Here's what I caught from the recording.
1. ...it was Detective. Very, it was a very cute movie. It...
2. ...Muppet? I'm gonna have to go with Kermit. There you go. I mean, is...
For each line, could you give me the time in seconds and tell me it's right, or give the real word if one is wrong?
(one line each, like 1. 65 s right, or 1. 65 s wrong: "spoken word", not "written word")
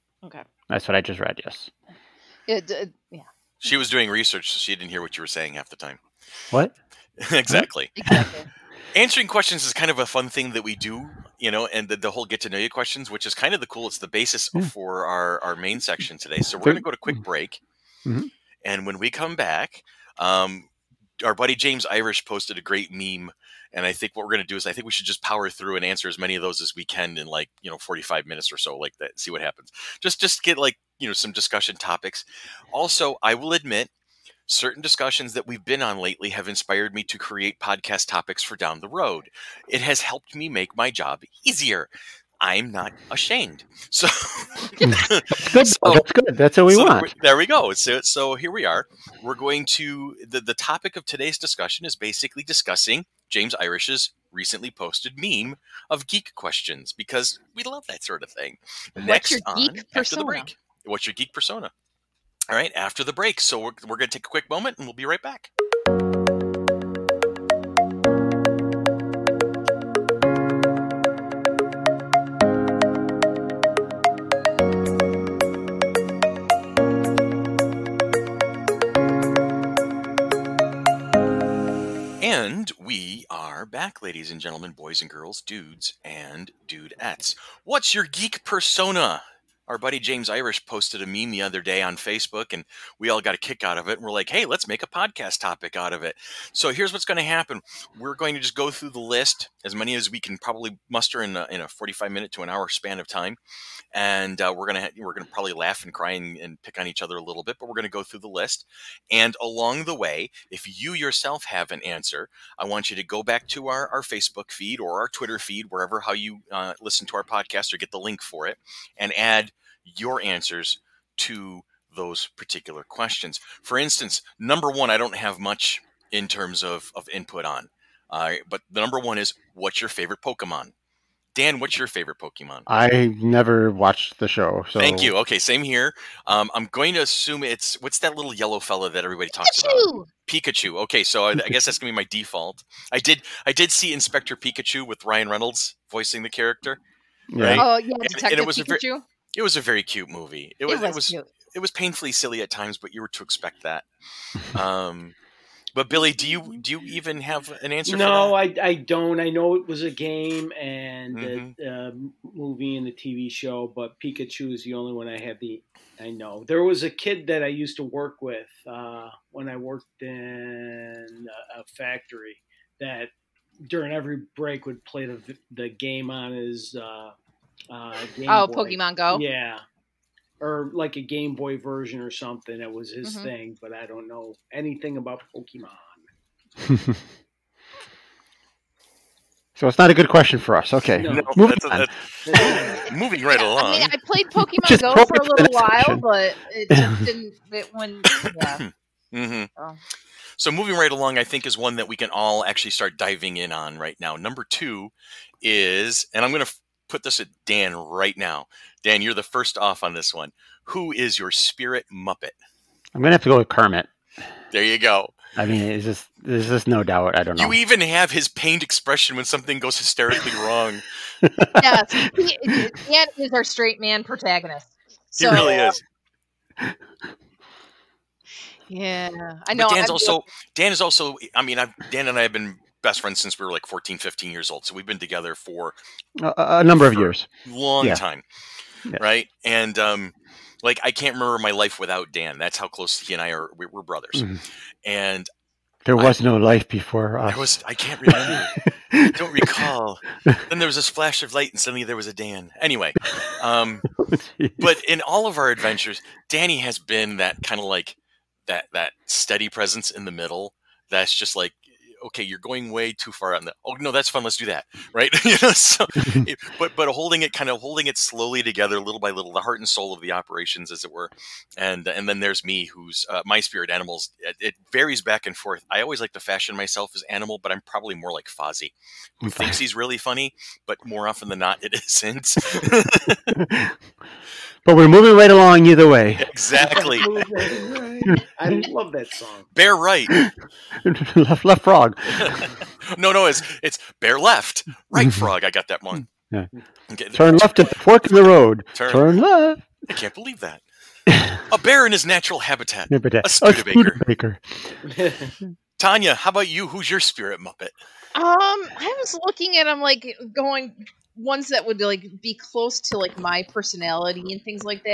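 1. 148 s wrong: "Pikachu", not "Detective"
2. 211 s right.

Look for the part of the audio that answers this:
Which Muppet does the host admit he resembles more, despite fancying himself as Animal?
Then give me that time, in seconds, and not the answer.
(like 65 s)
278 s.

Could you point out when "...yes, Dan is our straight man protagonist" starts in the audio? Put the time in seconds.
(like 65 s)
221 s.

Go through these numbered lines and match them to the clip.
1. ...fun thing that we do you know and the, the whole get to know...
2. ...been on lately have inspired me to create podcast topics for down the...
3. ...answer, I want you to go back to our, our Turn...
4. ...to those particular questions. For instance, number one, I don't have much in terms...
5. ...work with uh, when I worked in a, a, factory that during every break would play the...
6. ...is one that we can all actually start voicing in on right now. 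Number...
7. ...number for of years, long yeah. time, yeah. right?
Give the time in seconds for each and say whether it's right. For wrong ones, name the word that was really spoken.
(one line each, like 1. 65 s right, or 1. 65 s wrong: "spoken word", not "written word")
1. 10 s right
2. 35 s right
3. 111 s wrong: "Facebook", not "Turn"
4. 121 s right
5. 167 s right
6. 201 s wrong: "diving", not "voicing"
7. 236 s right.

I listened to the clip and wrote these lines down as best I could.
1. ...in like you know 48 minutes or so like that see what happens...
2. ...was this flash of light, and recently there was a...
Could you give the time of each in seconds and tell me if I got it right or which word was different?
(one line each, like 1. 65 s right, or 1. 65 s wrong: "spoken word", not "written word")
1. 27 s wrong: "45", not "48"
2. 250 s wrong: "suddenly", not "recently".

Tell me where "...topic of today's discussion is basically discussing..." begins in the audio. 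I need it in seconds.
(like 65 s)
50 s.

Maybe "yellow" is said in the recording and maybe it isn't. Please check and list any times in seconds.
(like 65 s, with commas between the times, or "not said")
138 s.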